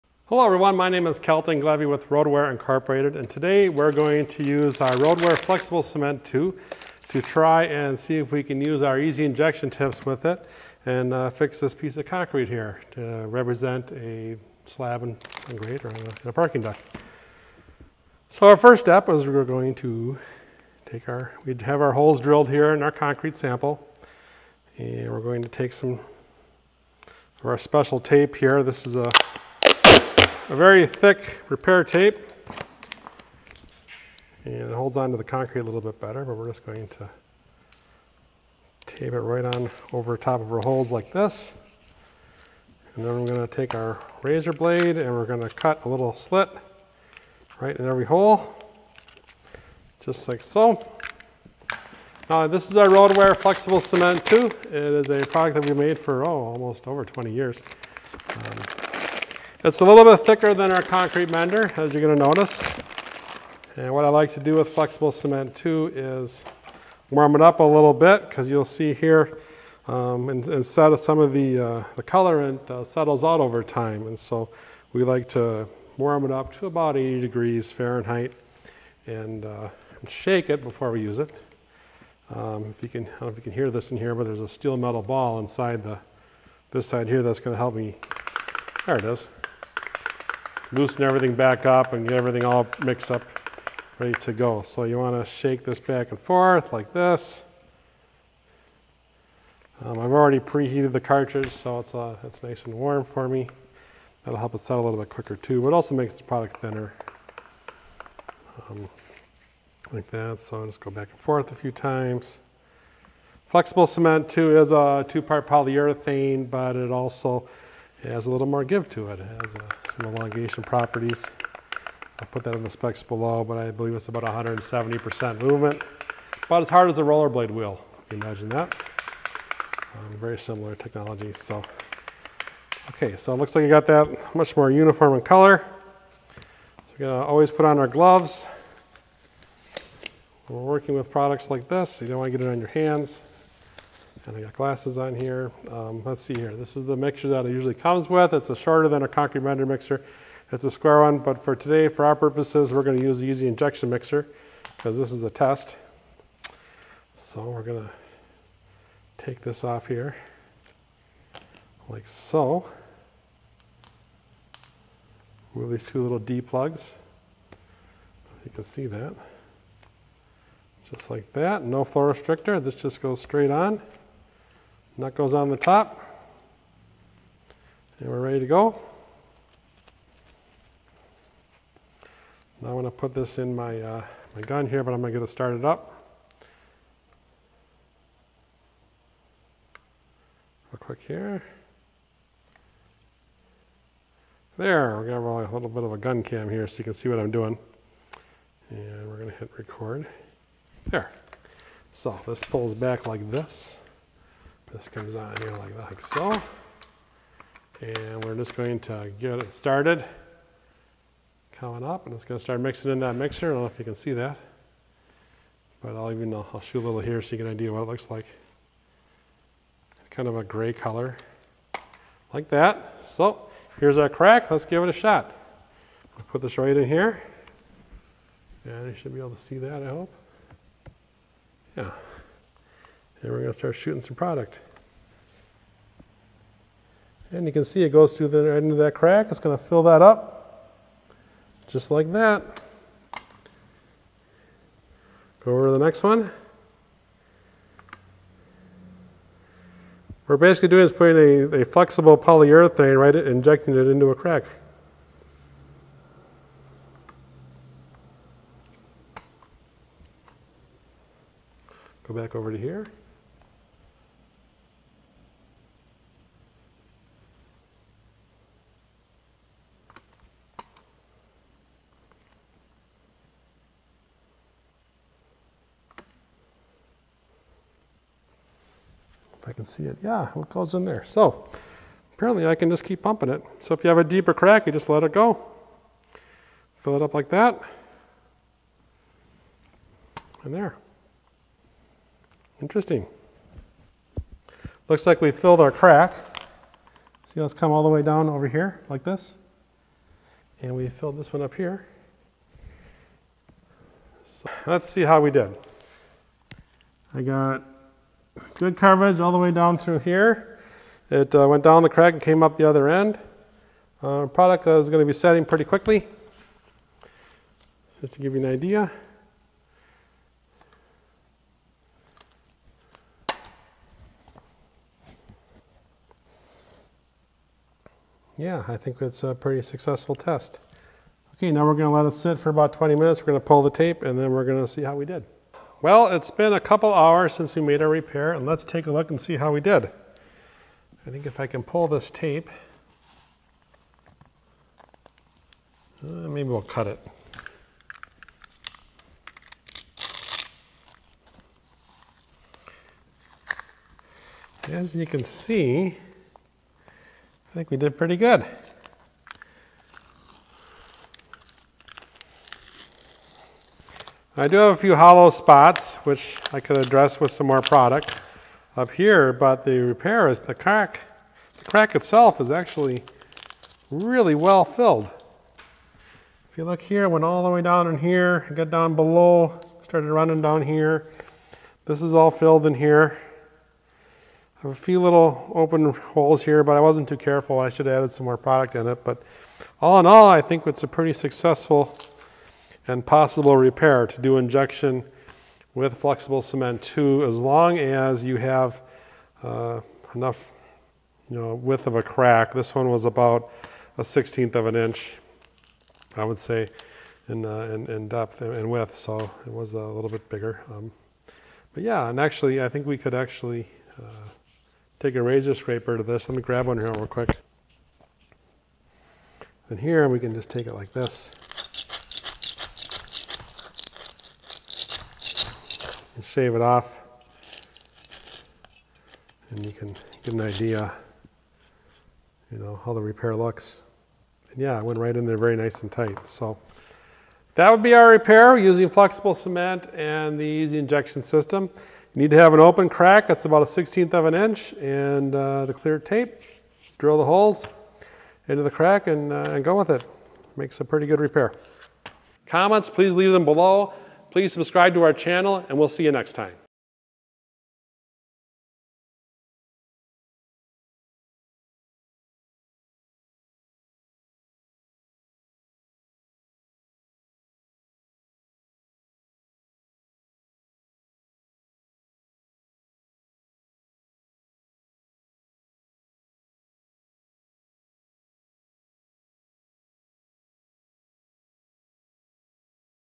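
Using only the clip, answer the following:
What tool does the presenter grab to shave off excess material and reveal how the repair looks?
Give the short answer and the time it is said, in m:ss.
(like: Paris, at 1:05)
razor scraper, at 6:55.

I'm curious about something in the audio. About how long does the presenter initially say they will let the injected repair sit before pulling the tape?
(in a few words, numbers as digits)
20 minutes.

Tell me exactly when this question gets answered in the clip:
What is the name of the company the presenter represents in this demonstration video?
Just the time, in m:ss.
0:02.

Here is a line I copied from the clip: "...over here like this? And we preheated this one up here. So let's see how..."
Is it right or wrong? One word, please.
wrong.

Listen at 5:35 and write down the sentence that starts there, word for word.
Well, it's been a couple hours since we made our repair and let's take a look and see how we did.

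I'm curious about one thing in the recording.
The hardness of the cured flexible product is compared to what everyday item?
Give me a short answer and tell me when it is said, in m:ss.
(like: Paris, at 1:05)
rollerblade wheel, at 2:07.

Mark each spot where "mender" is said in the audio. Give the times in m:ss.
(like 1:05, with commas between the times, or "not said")
1:01, 2:29.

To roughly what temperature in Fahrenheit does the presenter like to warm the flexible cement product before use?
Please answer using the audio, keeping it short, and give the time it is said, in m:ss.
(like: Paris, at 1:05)
80 degrees, at 1:16.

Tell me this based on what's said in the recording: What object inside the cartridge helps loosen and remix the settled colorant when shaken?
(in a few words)
steel metal ball.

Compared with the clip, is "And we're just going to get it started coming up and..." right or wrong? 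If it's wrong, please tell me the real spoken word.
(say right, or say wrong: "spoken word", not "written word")
right.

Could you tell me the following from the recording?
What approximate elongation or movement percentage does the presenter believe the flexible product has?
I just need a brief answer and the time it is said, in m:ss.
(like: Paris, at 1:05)
170%, at 2:04.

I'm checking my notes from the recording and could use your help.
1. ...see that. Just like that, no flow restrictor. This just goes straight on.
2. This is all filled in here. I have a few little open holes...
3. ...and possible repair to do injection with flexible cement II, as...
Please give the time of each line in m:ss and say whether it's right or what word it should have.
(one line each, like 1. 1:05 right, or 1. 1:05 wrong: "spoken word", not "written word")
1. 2:48 right
2. 6:21 right
3. 6:32 right.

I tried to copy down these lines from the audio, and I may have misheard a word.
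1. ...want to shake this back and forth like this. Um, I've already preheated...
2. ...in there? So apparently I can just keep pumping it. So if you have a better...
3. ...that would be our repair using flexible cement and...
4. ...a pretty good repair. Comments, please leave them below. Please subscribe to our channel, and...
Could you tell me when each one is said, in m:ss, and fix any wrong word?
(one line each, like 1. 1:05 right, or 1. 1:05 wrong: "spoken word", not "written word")
1. 1:34 right
2. 4:40 wrong: "deeper", not "better"
3. 7:17 right
4. 7:30 right.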